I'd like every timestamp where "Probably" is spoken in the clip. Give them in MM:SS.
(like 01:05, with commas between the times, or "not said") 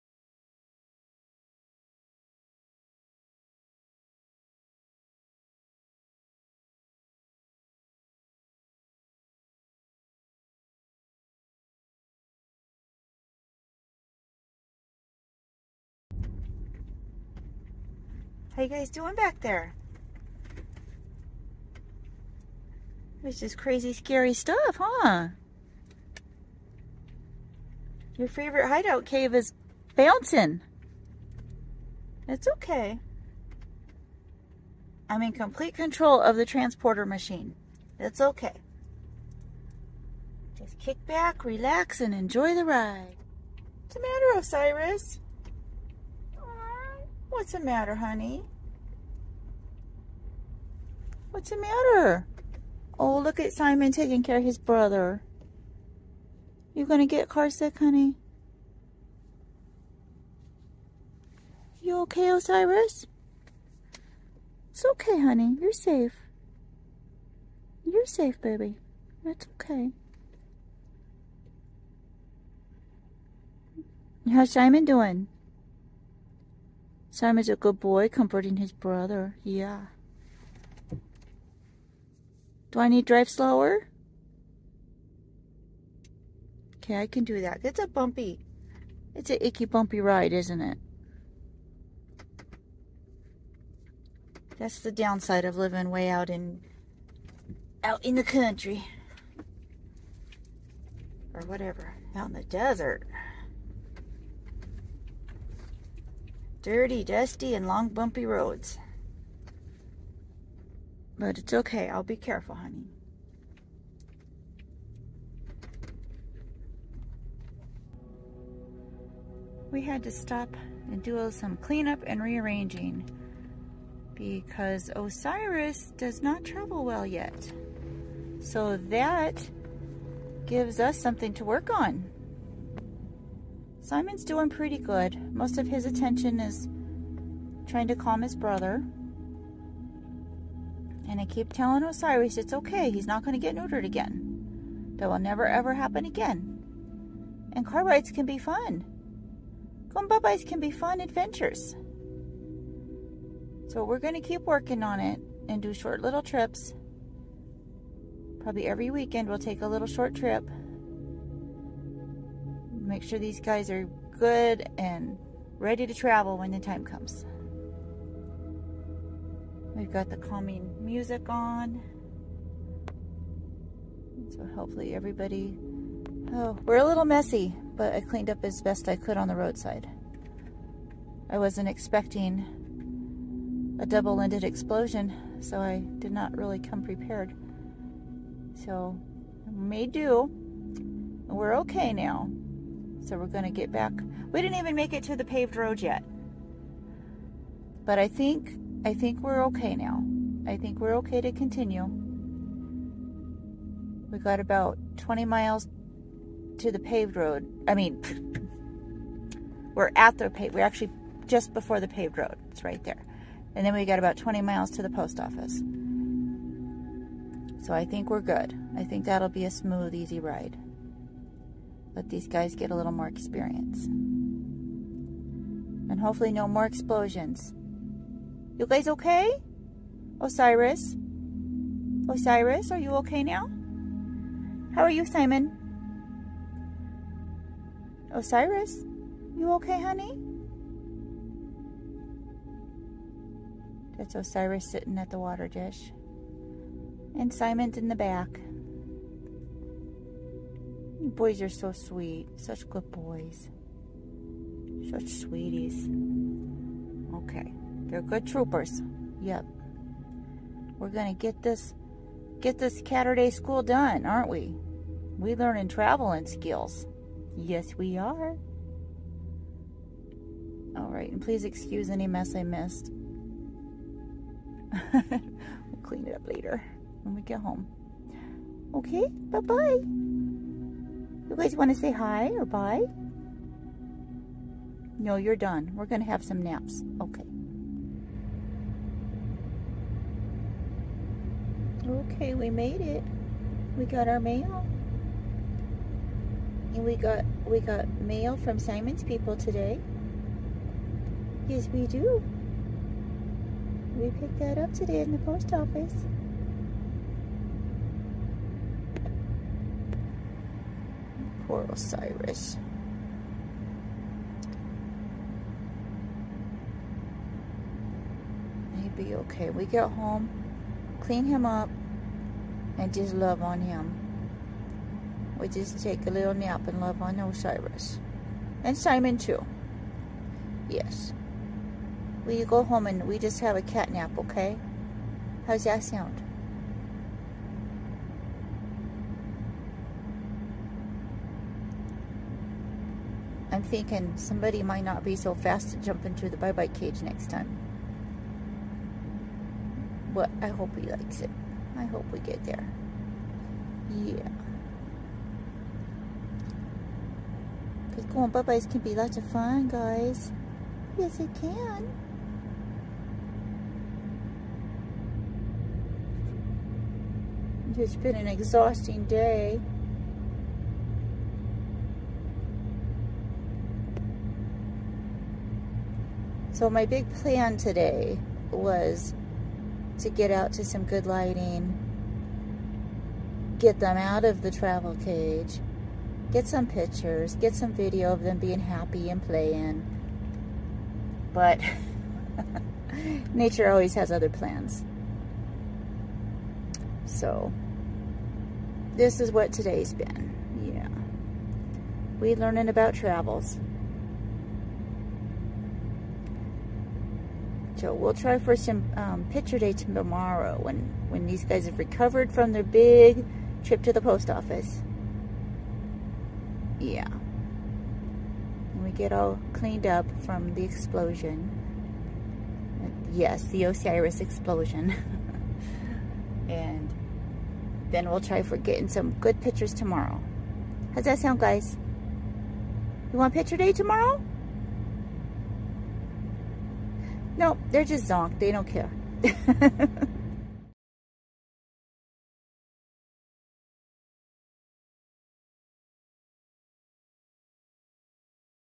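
02:38.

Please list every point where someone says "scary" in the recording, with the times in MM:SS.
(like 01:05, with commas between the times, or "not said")
00:23.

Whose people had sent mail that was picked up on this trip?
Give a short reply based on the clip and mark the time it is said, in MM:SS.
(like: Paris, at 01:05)
Simon's people, at 04:58.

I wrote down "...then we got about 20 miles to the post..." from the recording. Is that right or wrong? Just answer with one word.
right.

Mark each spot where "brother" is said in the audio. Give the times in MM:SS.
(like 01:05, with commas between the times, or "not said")
00:54, 01:18, 02:18.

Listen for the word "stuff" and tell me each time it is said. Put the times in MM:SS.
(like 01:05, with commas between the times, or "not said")
00:24.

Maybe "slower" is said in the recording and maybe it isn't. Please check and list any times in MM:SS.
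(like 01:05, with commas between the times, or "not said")
01:23.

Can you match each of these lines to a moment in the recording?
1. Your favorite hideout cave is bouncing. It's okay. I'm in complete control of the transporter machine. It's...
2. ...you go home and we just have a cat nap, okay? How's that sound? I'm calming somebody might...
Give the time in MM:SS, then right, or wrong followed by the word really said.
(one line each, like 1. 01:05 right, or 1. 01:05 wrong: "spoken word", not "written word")
1. 00:28 right
2. 05:32 wrong: "thinking", not "calming".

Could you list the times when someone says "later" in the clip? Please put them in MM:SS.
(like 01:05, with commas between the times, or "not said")
04:36.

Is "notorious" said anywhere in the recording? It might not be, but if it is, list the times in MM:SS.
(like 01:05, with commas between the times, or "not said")
not said.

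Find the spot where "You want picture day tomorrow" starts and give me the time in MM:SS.
07:13.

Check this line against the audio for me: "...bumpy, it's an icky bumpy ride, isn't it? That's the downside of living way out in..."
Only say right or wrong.
right.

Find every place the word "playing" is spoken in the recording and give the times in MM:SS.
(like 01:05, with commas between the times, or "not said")
06:29.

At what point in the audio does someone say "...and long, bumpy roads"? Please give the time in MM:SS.
01:47.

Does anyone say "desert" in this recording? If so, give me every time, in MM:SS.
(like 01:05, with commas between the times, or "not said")
01:42.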